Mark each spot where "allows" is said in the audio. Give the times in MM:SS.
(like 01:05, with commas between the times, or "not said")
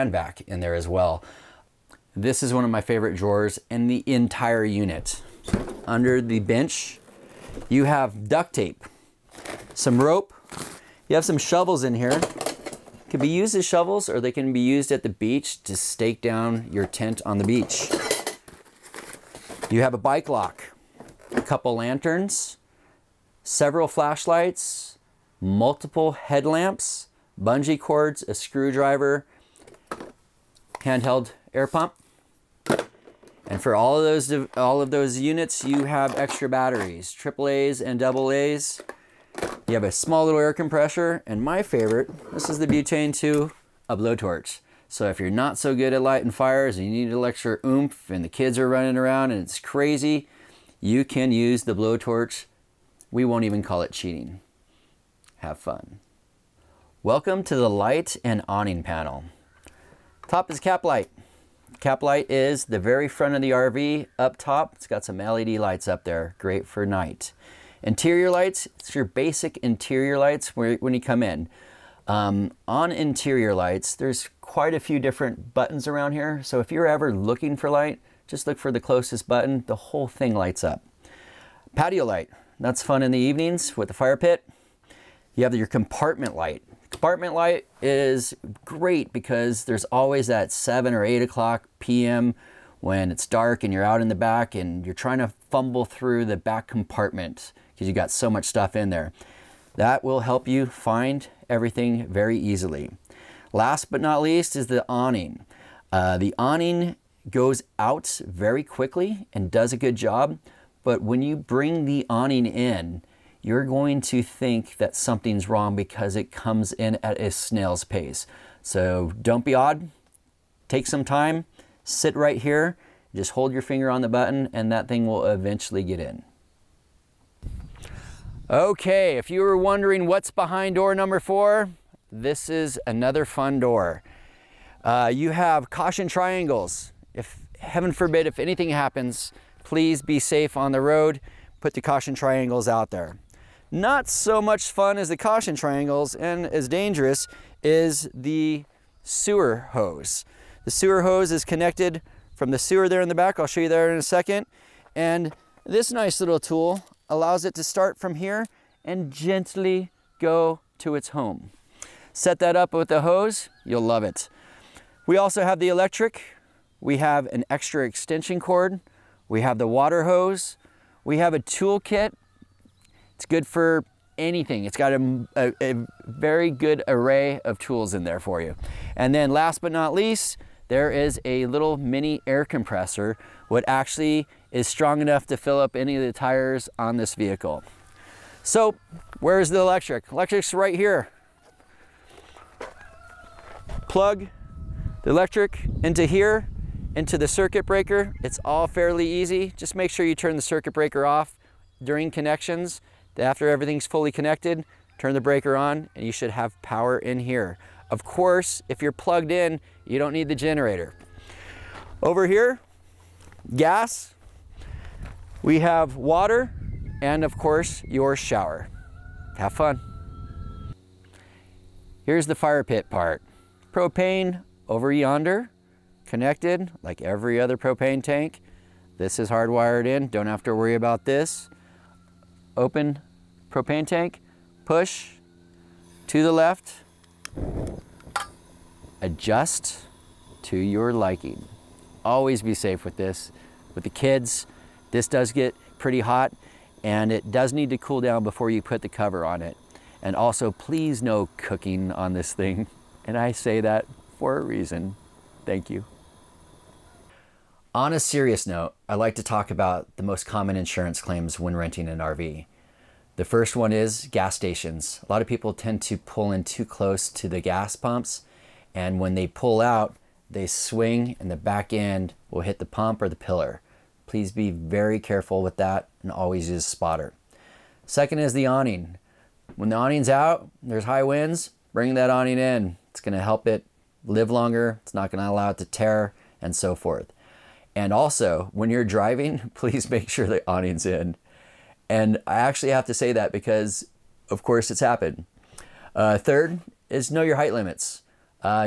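02:37, 04:45.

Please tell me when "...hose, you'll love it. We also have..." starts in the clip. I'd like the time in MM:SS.
02:43.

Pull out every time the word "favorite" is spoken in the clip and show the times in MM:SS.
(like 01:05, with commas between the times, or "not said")
00:02, 00:41.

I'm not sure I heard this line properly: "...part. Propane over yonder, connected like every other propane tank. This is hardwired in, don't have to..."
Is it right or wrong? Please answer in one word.
right.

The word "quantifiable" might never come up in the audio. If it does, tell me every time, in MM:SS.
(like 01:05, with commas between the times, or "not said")
not said.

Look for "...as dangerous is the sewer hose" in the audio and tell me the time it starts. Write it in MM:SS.
02:26.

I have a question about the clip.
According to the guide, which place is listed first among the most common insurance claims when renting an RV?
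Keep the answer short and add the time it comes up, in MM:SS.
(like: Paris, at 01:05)
Gas stations, at 04:24.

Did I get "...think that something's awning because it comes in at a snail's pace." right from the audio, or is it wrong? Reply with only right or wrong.
wrong.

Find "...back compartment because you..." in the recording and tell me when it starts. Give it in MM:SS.
01:36.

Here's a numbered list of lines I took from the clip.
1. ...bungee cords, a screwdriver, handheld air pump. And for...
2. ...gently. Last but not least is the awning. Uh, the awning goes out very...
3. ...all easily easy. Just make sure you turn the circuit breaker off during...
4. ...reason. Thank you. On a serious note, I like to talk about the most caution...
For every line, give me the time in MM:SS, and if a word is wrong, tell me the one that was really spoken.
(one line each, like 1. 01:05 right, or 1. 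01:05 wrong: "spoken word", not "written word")
1. 00:27 right
2. 01:42 wrong: "easily", not "gently"
3. 03:18 wrong: "fairly", not "easily"
4. 04:14 wrong: "common", not "caution".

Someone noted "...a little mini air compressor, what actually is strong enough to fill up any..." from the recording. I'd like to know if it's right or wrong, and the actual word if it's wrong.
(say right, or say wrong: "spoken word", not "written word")
right.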